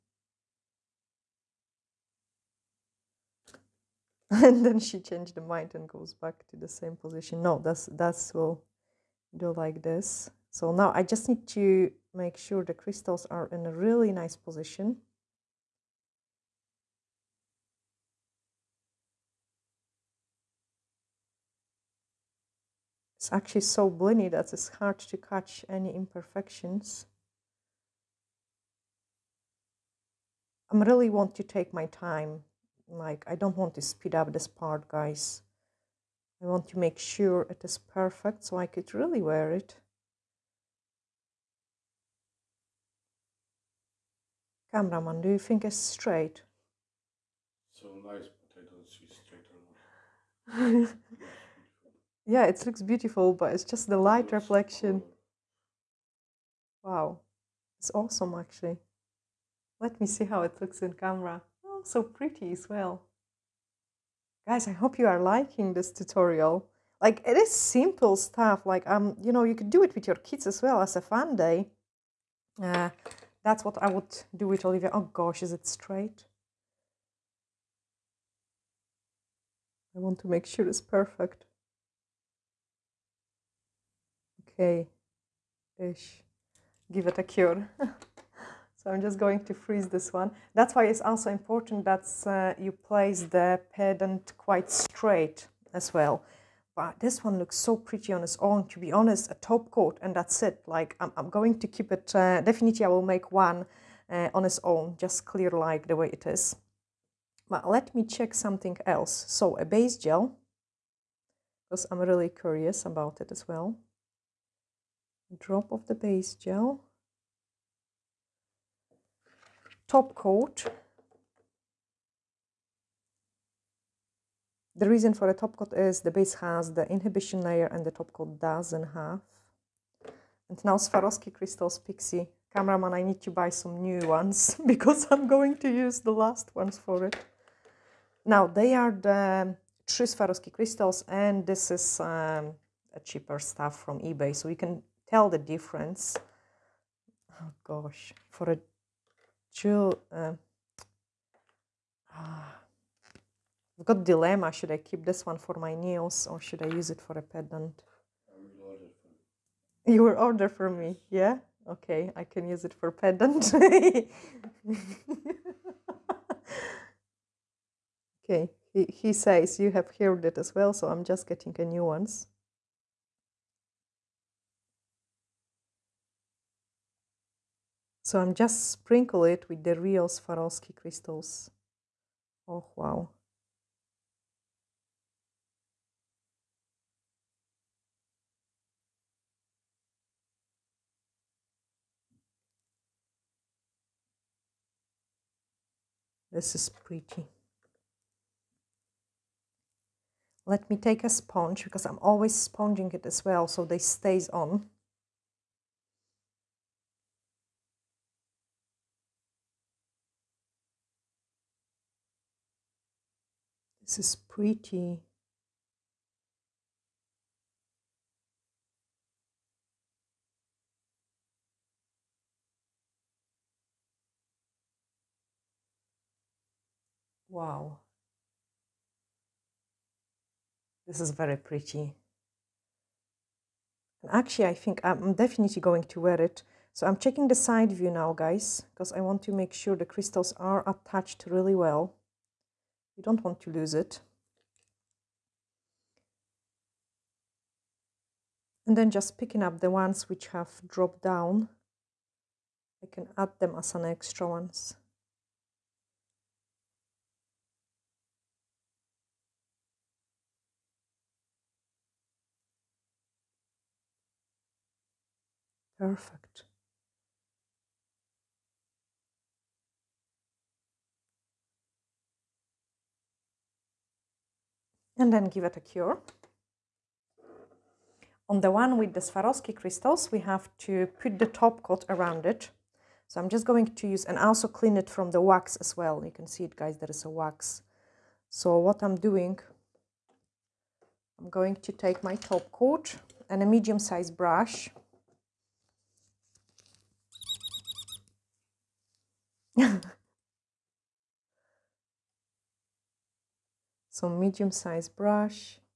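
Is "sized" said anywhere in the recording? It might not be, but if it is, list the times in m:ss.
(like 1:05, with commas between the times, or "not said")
4:53, 5:04.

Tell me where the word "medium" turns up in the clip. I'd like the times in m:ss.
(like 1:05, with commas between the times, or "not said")
4:53, 5:04.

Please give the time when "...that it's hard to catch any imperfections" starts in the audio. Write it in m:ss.
0:24.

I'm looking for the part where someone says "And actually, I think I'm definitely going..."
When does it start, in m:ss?
3:54.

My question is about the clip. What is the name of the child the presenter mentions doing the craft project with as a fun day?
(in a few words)
Olivia.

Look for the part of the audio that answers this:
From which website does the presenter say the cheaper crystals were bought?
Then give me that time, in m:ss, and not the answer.
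2:23.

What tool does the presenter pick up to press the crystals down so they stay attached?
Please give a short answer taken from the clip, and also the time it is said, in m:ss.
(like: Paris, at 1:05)
A sponge, at 3:21.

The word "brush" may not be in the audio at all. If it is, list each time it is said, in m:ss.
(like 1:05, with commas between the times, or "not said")
4:54, 5:04.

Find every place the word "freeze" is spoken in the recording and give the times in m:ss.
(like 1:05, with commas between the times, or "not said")
1:29.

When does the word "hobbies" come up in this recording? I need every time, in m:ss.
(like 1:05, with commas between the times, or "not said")
not said.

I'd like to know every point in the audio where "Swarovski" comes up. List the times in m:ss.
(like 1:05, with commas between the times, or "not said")
2:10, 2:20, 3:00, 4:39.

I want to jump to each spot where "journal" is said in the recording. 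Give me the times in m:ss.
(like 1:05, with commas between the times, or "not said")
not said.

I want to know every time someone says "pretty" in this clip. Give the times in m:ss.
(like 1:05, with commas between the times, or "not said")
1:02, 1:37, 3:16, 3:34, 3:51.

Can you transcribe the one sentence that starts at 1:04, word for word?
Guys, I hope you are liking this tutorial.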